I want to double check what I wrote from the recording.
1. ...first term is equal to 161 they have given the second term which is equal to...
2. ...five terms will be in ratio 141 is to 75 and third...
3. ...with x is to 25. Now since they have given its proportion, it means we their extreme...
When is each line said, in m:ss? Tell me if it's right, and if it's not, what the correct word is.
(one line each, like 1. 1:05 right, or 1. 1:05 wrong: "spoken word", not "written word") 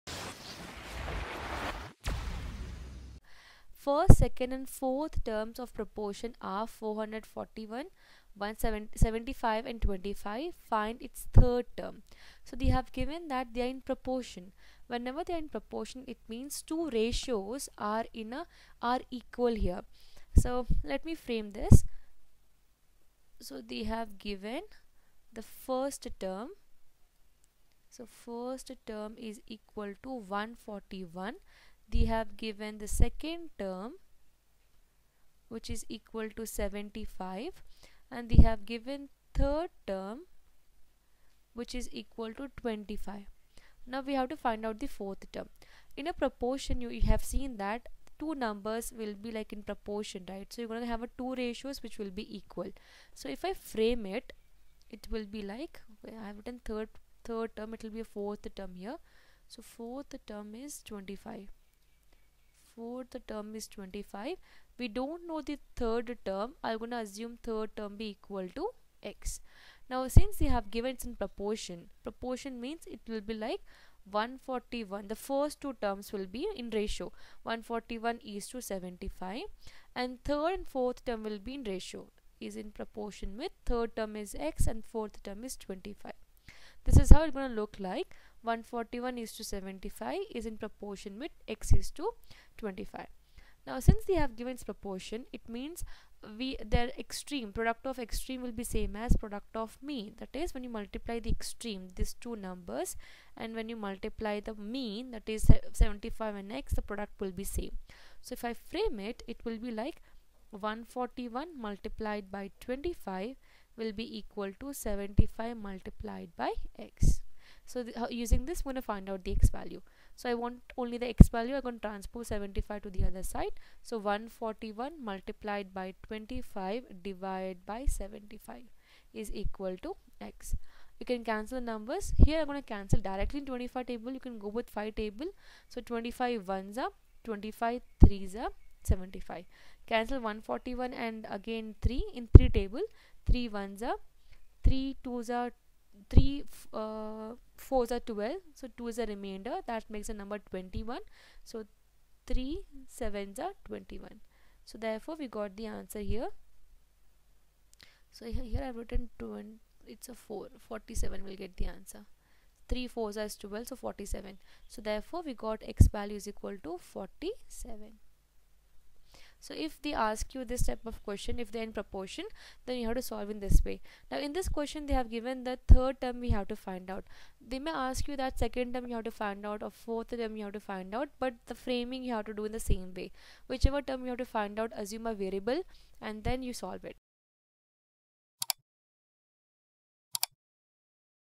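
1. 0:28 wrong: "141", not "161"
2. 1:15 wrong: "two", not "five"
3. 1:31 right.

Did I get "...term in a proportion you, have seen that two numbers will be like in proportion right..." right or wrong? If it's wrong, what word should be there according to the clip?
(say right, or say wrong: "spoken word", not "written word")
right.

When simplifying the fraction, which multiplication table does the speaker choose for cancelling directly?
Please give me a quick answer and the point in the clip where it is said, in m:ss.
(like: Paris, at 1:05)
25 table, at 2:13.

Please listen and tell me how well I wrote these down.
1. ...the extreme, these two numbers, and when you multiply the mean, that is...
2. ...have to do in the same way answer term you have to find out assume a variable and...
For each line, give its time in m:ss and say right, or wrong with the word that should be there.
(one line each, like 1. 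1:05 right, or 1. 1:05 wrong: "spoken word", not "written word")
1. 1:41 right
2. 3:02 wrong: "whichever", not "answer".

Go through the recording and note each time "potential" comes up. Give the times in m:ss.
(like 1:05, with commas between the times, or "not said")
not said.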